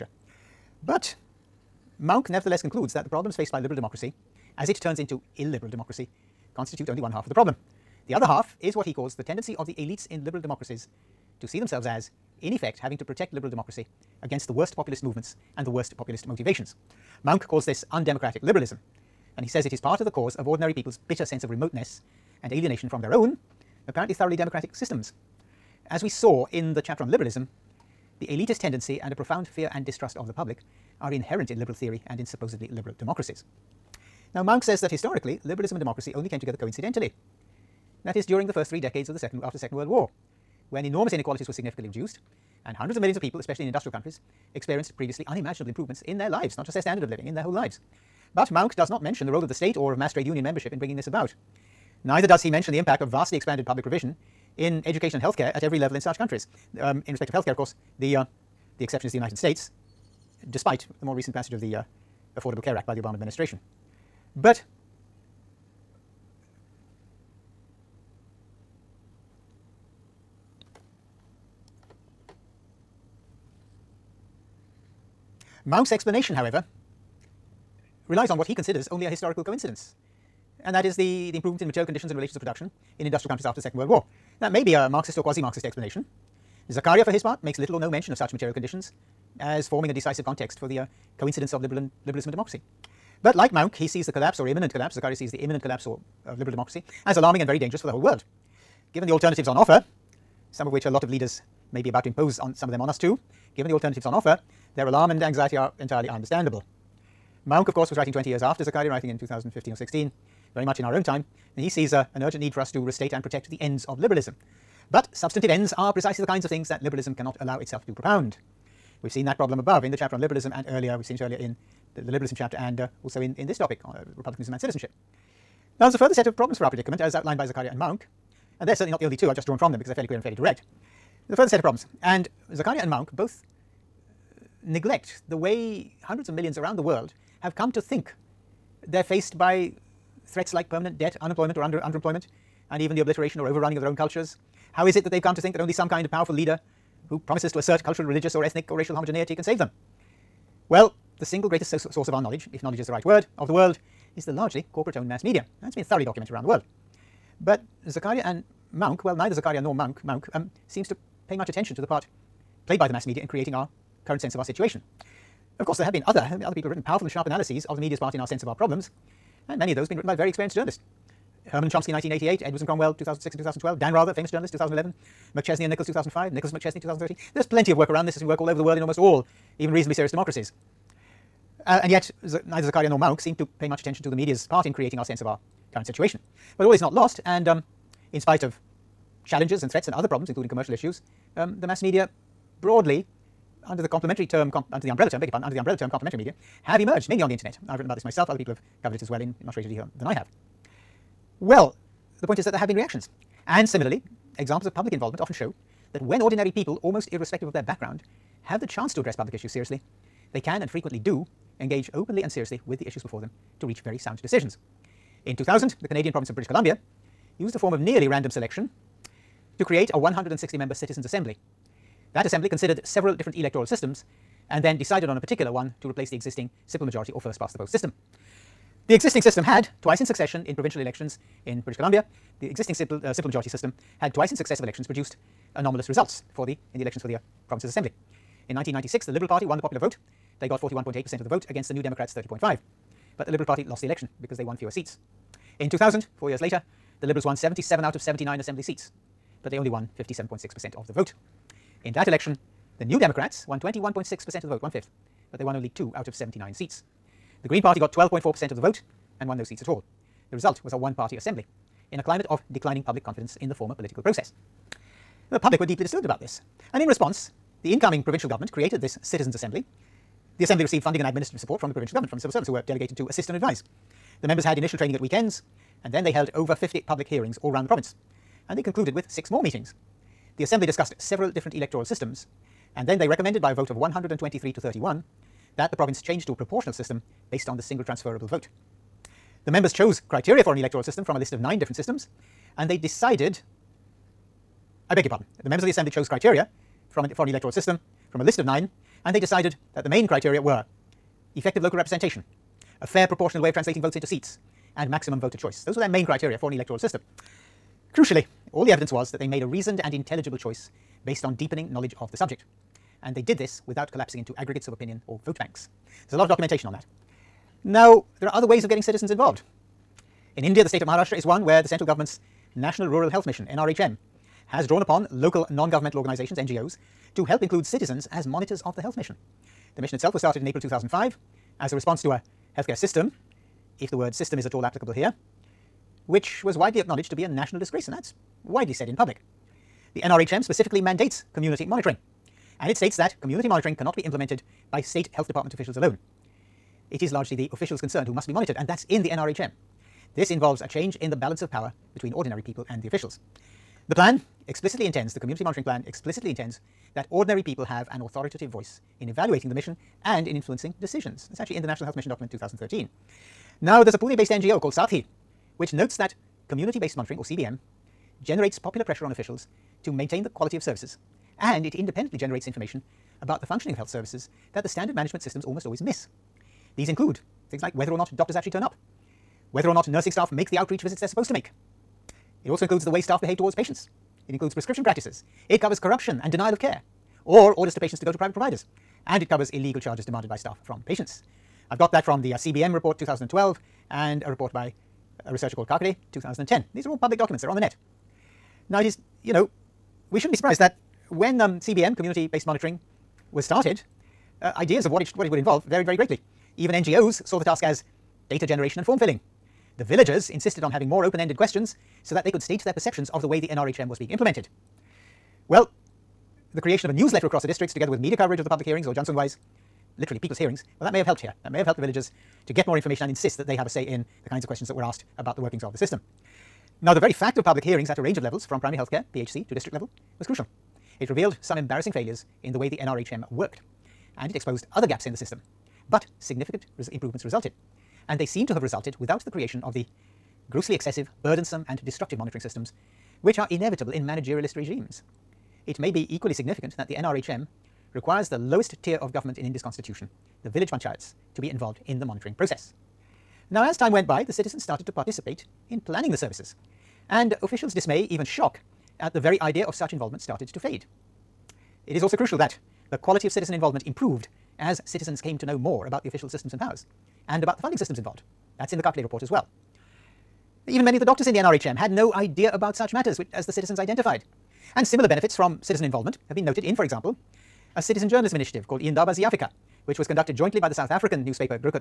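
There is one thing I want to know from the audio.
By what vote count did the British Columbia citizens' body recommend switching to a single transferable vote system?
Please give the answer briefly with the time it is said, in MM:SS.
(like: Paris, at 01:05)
123 to 31, at 04:43.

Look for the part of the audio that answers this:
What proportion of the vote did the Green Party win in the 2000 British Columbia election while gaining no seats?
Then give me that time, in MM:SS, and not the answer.
04:17.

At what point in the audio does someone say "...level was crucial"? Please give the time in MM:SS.
07:09.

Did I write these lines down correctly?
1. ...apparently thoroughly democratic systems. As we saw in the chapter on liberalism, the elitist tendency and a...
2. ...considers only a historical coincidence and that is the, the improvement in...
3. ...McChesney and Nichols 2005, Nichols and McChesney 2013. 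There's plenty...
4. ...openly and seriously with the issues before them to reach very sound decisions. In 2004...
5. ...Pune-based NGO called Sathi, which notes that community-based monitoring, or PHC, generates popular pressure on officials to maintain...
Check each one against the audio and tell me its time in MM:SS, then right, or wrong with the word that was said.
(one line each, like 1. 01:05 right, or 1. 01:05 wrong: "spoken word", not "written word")
1. 00:23 right
2. 01:18 right
3. 02:55 right
4. 03:31 wrong: "2000", not "2004"
5. 06:03 wrong: "CBM", not "PHC".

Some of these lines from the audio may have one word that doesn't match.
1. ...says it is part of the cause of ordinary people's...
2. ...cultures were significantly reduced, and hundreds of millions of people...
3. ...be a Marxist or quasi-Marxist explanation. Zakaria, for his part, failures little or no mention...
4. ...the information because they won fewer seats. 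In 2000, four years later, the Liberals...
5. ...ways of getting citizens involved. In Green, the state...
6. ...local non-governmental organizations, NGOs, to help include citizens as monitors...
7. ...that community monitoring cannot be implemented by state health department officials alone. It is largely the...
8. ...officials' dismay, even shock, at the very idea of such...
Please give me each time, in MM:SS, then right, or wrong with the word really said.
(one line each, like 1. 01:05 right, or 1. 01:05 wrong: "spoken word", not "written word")
1. 00:19 right
2. 00:41 wrong: "inequalities", not "cultures"
3. 01:24 wrong: "makes", not "failures"
4. 04:03 wrong: "election", not "information"
5. 05:18 wrong: "India", not "Green"
6. 05:25 right
7. 05:42 right
8. 07:37 right.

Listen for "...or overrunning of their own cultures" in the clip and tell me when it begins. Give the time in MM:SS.
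02:23.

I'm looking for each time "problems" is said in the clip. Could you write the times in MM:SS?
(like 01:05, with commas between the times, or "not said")
00:03, 00:07, 01:59, 02:06, 02:11, 02:48, 03:10.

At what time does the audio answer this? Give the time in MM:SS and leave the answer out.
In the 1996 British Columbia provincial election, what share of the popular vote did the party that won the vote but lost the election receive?
04:00.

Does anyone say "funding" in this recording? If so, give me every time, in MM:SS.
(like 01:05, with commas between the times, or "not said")
04:30, 07:47.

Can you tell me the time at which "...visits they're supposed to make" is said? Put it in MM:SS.
06:20.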